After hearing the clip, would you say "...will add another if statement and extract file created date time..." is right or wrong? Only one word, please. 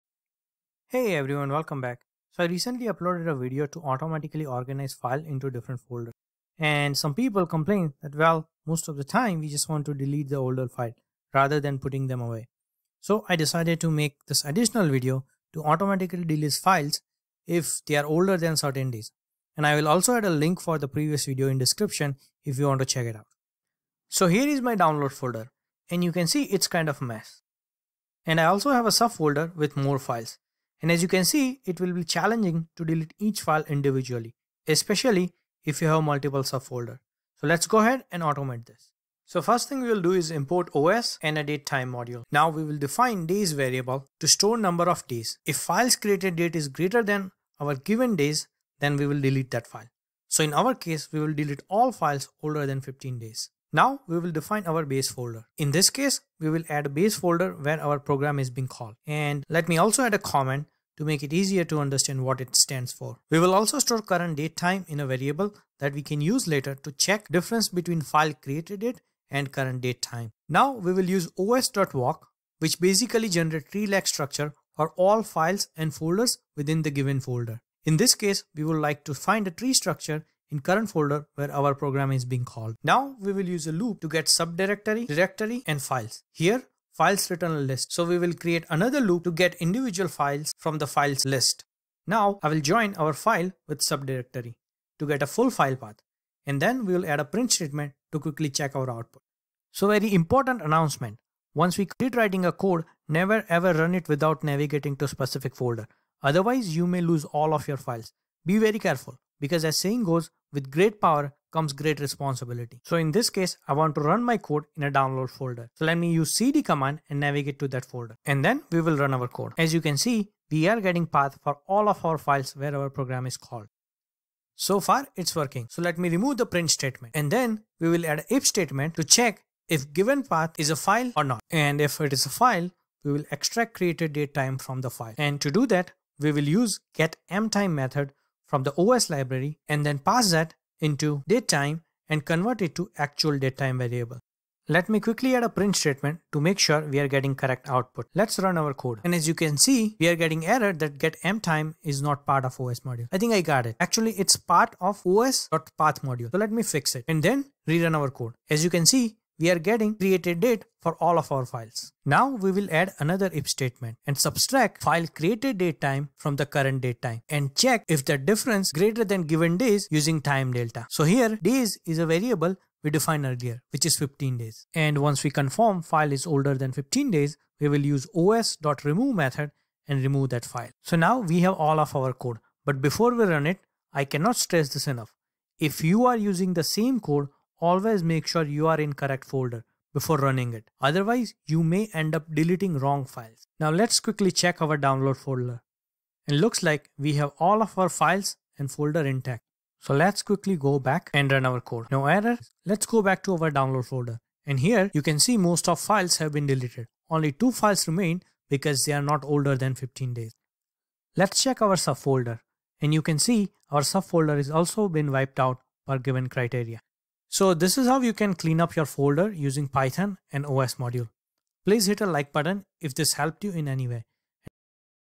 wrong.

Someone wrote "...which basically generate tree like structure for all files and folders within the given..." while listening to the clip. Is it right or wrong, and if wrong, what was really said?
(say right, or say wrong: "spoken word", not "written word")
right.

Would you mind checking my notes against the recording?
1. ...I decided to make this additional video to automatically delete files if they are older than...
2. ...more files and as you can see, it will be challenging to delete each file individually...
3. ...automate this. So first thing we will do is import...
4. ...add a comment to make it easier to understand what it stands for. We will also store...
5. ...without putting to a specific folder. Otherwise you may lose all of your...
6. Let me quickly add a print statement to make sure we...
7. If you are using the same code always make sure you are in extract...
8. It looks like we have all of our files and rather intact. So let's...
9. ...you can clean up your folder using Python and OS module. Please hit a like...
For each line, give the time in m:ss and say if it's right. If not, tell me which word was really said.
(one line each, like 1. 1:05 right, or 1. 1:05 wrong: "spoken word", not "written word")
1. 0:13 right
2. 0:29 right
3. 0:38 right
4. 1:00 right
5. 1:44 wrong: "navigating", not "putting"
6. 2:24 right
7. 3:05 wrong: "correct", not "extract"
8. 3:16 wrong: "folder", not "rather"
9. 3:38 right.